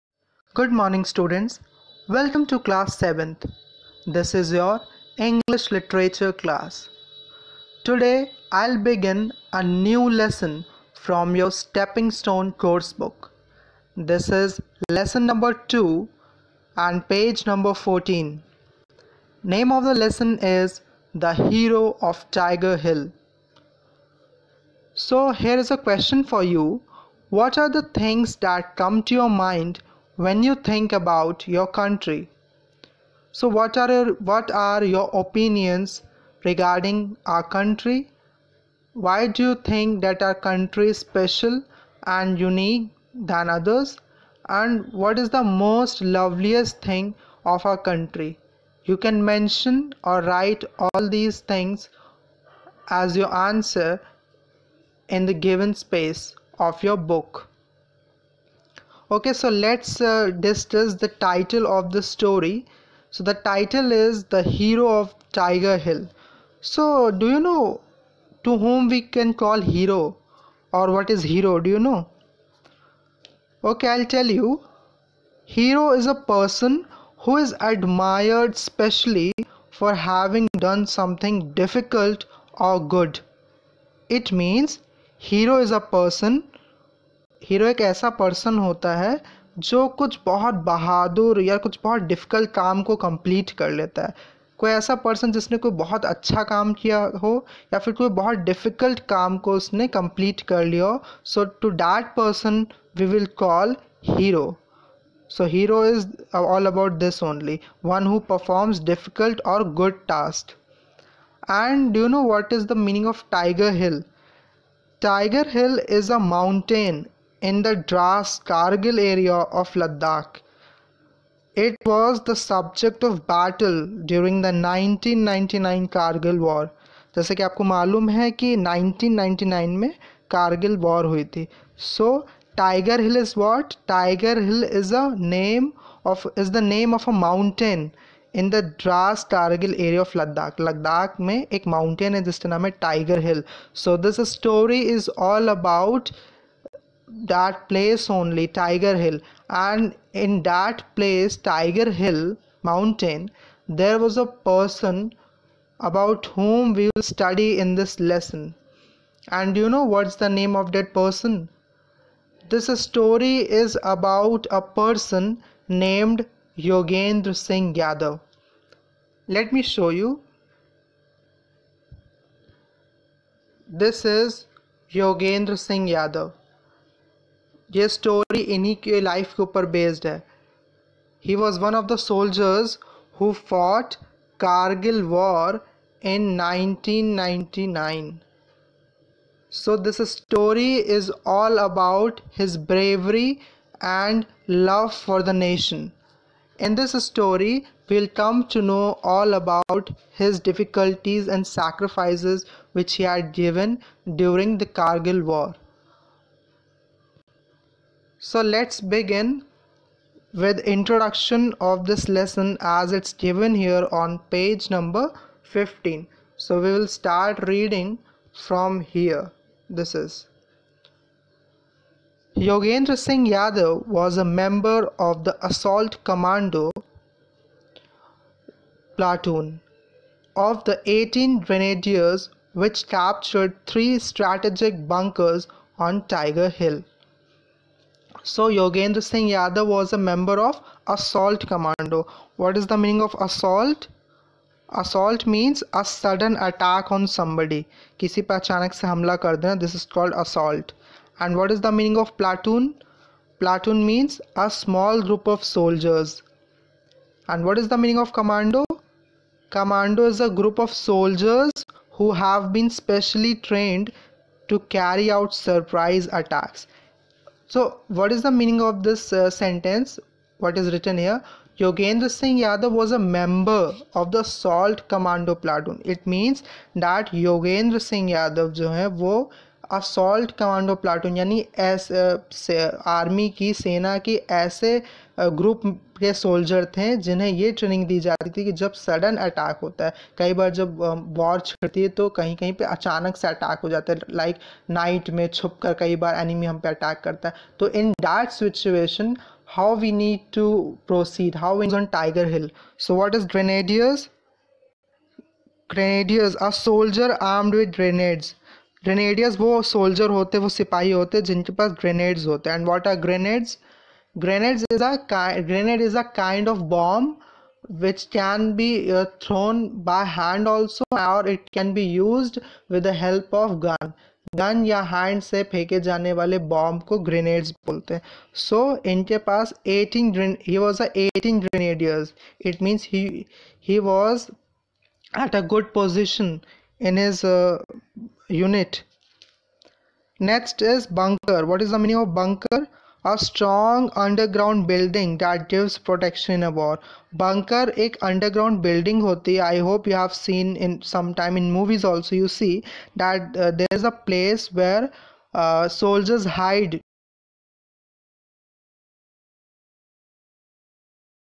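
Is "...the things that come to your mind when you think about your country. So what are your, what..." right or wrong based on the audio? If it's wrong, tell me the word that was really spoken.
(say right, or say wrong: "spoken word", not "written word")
right.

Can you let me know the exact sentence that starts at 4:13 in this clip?
Platoon means a small group of soldiers.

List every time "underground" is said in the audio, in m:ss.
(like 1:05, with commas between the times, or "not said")
5:43, 5:48.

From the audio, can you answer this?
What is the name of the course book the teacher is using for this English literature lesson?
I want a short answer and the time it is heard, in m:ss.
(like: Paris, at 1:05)
Stepping Stone, at 0:11.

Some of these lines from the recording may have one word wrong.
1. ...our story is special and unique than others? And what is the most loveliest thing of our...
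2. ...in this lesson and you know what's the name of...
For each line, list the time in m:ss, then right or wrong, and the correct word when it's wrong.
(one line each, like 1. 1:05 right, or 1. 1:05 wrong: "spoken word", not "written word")
1. 0:40 wrong: "country", not "story"
2. 2:37 right.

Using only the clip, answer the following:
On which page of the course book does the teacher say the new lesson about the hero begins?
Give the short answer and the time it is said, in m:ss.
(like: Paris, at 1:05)
14, at 0:17.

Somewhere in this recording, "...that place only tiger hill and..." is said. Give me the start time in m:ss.
2:27.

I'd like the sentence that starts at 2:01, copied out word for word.
It was the subject of battle during the 1999 Kargil War.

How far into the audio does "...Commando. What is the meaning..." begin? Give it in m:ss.
4:01.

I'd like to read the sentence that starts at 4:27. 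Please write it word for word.
So what is the meaning of this uh, sentence?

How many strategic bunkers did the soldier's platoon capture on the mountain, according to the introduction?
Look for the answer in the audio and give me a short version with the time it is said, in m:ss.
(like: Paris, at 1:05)
3, at 3:53.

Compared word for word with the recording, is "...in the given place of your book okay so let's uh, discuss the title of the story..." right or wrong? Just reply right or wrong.
wrong.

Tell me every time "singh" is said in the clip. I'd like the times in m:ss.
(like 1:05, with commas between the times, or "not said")
2:47, 2:55, 3:42, 3:59, 4:32, 4:37.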